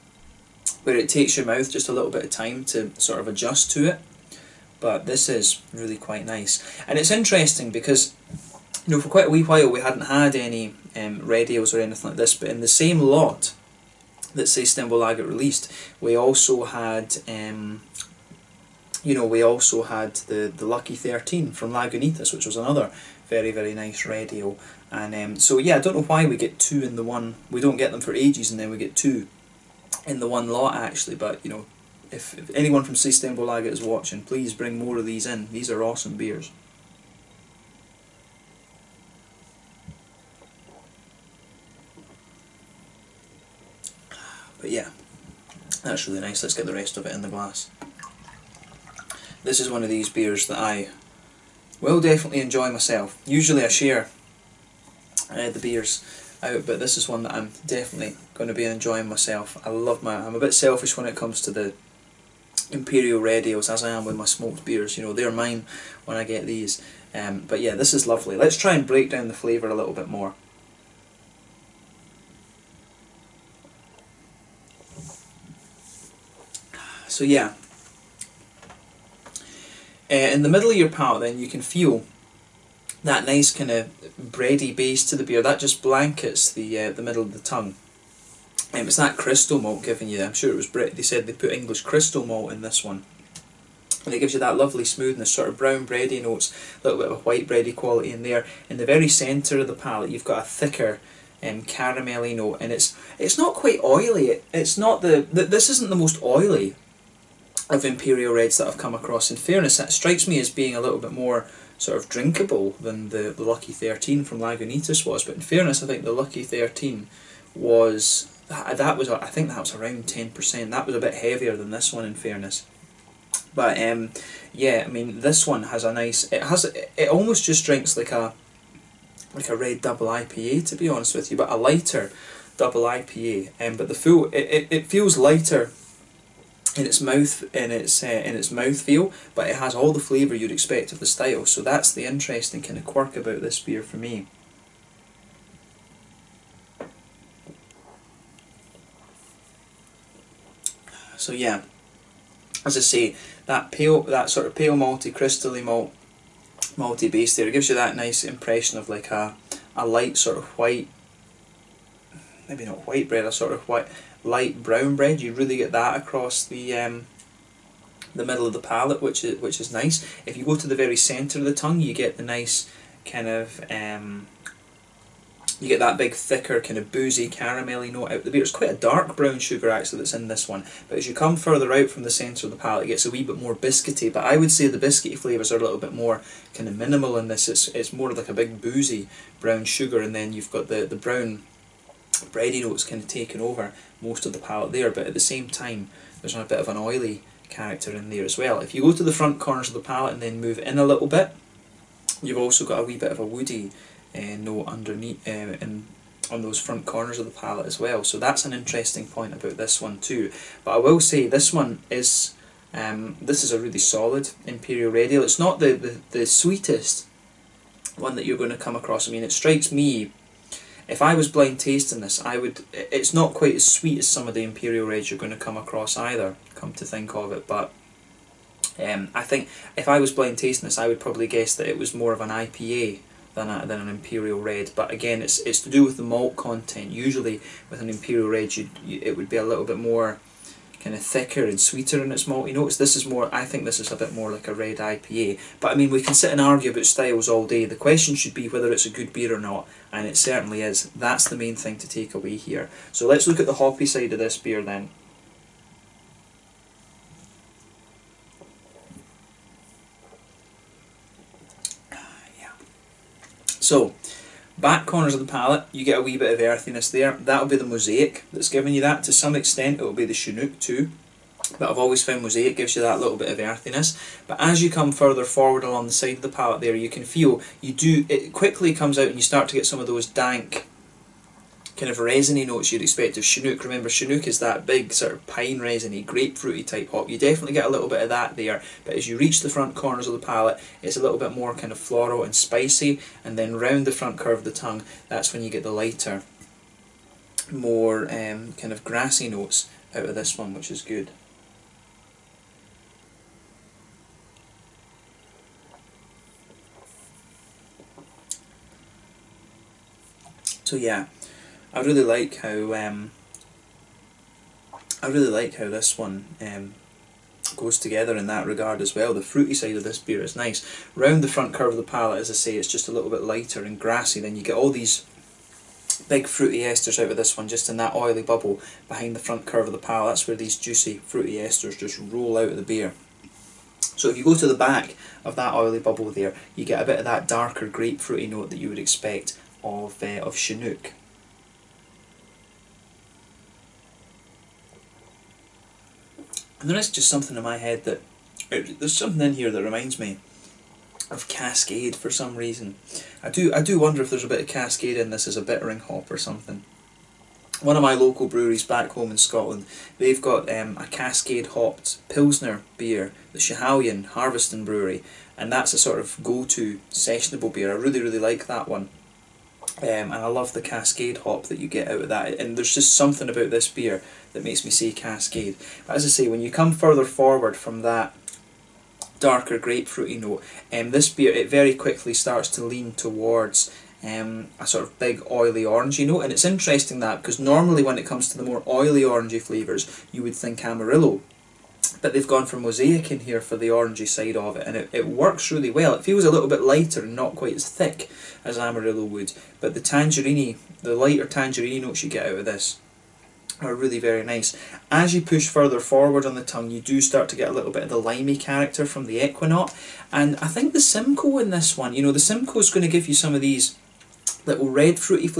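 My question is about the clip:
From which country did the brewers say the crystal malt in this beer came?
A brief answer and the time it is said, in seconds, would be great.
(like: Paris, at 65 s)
English, at 91 s.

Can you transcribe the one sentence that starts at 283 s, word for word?
Remember, Chinook is that big sort of pine resiny, grapefruity type hop.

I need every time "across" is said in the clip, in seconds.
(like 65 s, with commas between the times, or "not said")
108 s, 166 s, 218 s, 225 s.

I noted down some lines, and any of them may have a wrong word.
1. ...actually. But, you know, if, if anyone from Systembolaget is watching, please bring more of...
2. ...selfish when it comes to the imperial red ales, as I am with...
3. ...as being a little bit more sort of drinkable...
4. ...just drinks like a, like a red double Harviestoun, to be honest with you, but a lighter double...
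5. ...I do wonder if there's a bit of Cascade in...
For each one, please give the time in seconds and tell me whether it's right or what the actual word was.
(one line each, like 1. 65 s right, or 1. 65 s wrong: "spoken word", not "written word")
1. 30 s right
2. 60 s right
3. 110 s right
4. 127 s wrong: "IPA", not "Harviestoun"
5. 353 s right.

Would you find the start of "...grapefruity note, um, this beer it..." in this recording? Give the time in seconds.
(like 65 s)
379 s.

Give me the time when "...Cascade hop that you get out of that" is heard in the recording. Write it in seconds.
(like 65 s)
370 s.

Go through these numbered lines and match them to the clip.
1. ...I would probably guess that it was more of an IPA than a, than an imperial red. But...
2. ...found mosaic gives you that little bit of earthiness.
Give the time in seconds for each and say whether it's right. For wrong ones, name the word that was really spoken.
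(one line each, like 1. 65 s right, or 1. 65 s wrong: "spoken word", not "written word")
1. 230 s right
2. 272 s right.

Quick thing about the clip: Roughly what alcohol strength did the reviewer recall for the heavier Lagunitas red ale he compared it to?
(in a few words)
10%.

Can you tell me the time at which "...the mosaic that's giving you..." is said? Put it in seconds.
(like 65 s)
267 s.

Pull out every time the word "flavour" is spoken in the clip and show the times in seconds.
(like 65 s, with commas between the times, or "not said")
69 s, 139 s, 185 s, 389 s.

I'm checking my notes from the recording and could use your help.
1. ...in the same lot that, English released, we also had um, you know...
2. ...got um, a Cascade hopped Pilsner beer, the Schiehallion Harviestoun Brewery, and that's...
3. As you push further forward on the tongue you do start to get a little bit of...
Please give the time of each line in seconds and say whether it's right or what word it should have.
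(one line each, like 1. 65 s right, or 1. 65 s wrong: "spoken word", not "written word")
1. 12 s wrong: "Systembolaget", not "English"
2. 360 s right
3. 404 s right.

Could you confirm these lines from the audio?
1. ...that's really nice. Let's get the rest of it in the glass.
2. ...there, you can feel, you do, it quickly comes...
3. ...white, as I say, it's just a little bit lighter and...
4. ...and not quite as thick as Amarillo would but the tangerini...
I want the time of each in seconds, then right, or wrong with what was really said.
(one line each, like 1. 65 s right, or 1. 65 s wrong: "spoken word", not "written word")
1. 45 s right
2. 276 s right
3. 321 s wrong: "palate", not "white"
4. 397 s right.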